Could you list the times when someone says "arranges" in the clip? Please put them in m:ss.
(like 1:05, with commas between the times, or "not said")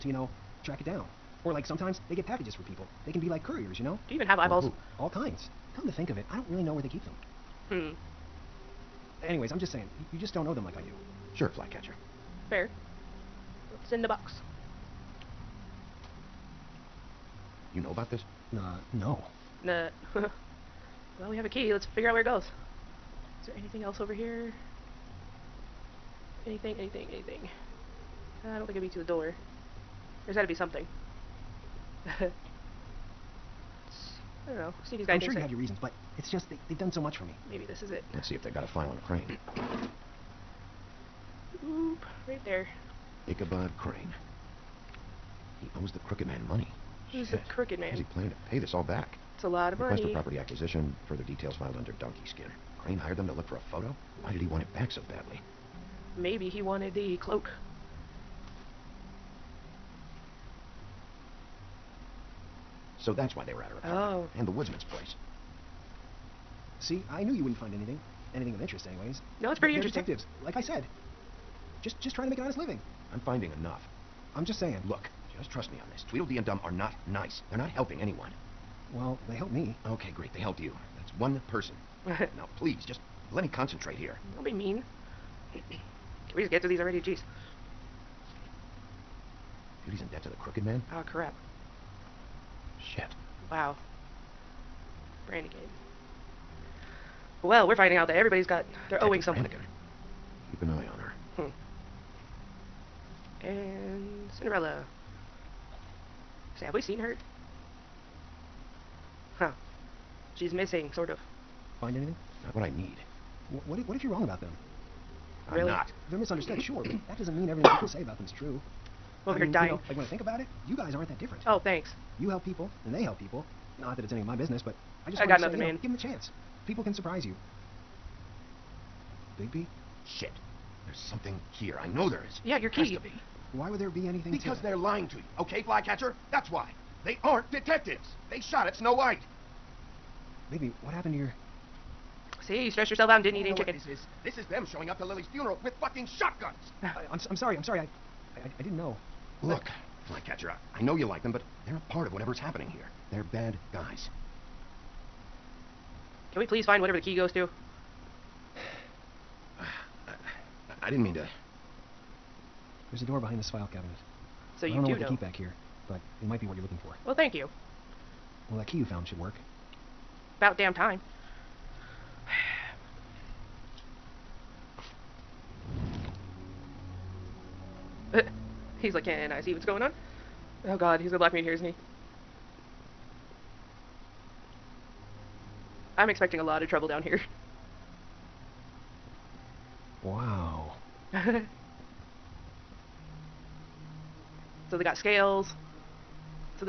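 not said.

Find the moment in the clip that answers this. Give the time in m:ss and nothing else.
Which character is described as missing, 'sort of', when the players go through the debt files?
1:44.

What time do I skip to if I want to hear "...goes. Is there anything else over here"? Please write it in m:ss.
0:22.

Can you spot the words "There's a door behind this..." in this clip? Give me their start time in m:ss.
2:42.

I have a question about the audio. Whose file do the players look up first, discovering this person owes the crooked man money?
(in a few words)
Ichabod Crane.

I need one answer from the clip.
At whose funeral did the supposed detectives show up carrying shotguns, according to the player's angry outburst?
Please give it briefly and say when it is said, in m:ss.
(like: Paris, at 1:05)
Lily's, at 2:25.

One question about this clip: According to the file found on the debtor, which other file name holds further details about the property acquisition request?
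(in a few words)
Donkey Skin.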